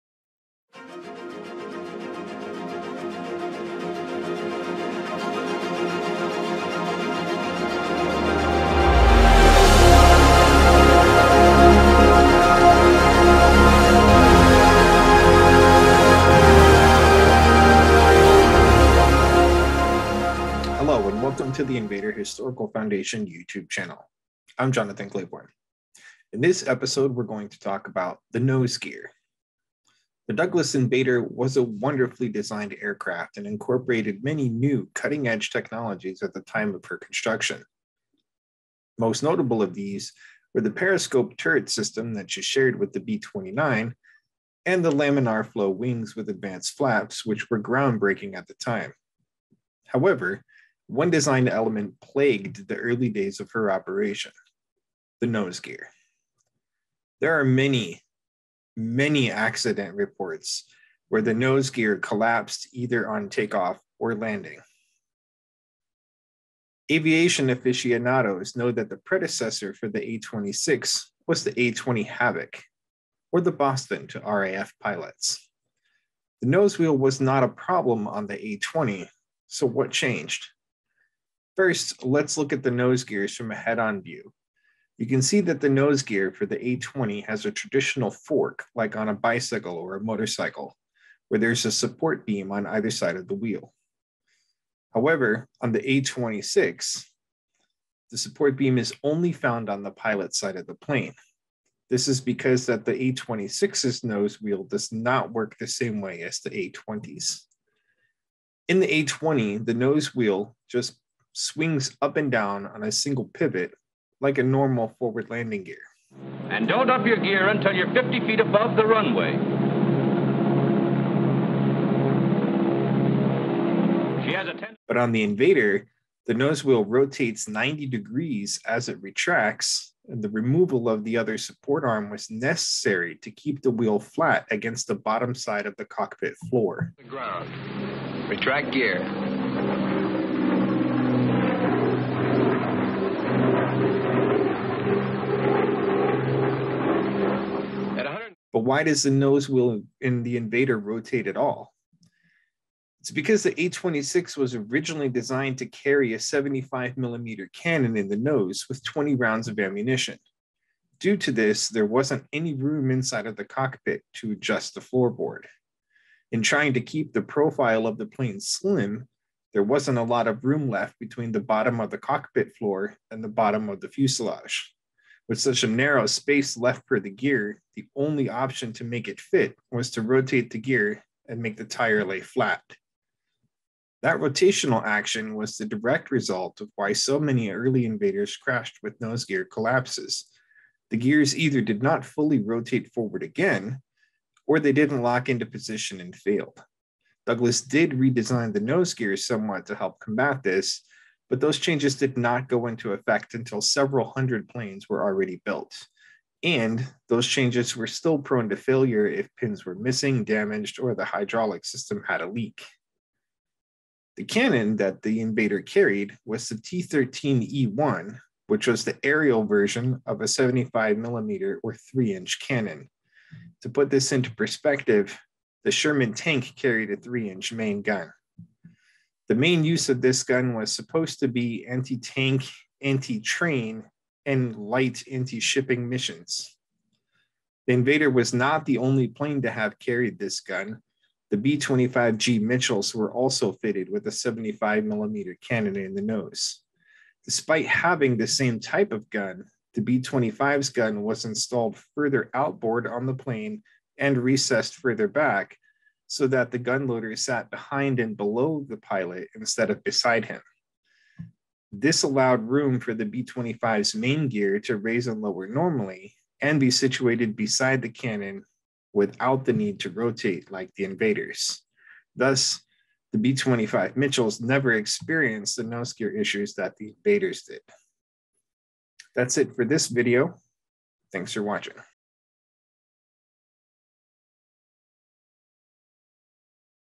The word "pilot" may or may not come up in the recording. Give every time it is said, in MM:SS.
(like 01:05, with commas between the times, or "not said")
01:14, 01:39, 04:18.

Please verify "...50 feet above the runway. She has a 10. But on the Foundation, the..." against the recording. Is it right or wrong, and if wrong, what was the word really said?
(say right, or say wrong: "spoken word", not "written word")
wrong: "Invader", not "Foundation".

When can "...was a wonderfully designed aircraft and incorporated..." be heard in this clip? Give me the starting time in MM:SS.
00:31.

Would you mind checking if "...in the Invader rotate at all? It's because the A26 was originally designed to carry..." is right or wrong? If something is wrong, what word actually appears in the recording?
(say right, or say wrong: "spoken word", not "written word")
right.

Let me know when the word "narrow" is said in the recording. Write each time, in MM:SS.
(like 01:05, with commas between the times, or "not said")
02:55.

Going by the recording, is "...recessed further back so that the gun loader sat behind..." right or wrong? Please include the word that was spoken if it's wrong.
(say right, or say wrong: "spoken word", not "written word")
right.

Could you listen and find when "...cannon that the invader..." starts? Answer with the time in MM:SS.
03:34.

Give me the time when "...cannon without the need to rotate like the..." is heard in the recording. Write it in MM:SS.
04:27.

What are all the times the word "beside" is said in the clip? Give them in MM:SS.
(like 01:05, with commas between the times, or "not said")
04:19, 04:27.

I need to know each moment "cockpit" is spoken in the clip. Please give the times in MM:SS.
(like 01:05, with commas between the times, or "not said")
02:15, 02:43, 02:51.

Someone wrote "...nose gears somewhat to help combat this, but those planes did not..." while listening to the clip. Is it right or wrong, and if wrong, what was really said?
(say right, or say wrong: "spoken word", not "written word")
wrong: "changes", not "planes".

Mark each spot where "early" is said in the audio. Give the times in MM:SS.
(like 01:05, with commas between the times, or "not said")
00:52, 03:07.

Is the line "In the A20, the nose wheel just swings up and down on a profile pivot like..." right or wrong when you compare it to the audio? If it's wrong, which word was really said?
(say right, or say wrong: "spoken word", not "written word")
wrong: "single", not "profile".